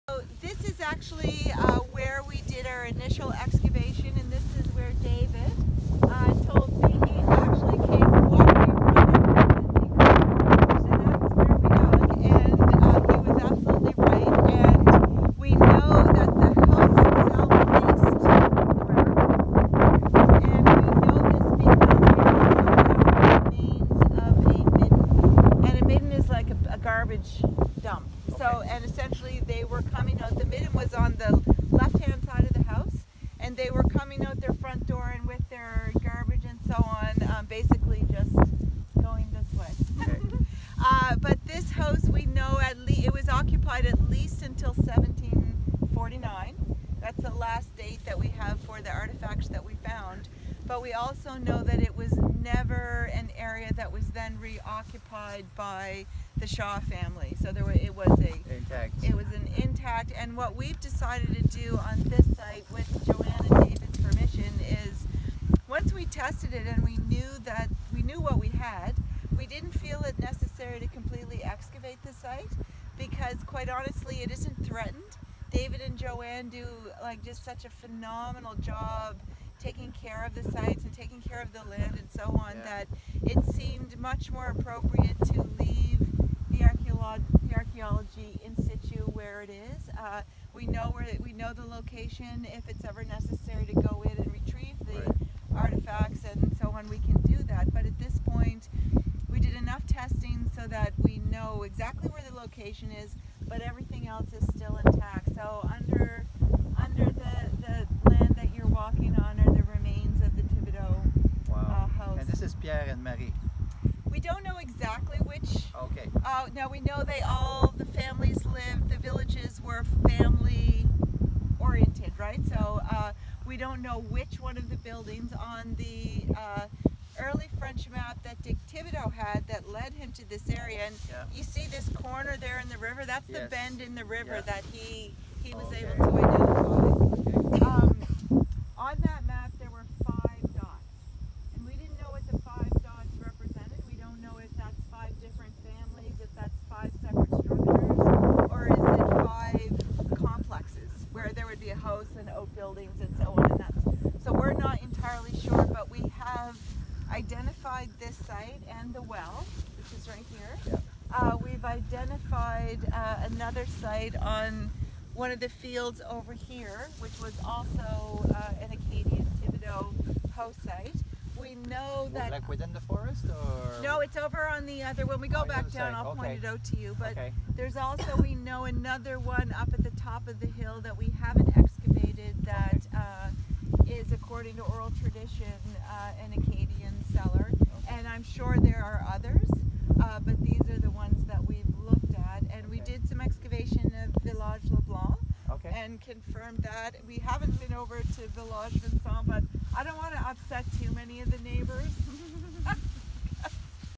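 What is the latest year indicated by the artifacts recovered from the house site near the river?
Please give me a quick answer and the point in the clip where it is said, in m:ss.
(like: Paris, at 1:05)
1749, at 0:44.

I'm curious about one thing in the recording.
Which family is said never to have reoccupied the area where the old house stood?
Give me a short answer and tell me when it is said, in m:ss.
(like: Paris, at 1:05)
Shaw family, at 0:56.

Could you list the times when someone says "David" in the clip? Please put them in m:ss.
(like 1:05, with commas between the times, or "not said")
0:05, 1:03, 1:15.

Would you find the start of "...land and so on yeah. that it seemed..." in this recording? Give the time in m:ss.
1:21.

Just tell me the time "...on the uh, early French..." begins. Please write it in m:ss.
2:05.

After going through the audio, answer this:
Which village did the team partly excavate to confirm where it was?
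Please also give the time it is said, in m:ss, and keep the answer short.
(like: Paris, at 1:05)
Village Leblanc, at 3:14.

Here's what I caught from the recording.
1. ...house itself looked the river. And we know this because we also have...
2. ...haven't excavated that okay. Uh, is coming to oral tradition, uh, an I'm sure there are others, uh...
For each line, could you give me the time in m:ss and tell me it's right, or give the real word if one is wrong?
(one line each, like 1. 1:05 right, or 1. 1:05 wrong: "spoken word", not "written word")
1. 0:16 wrong: "faced", not "looked"
2. 3:01 wrong: "according", not "coming".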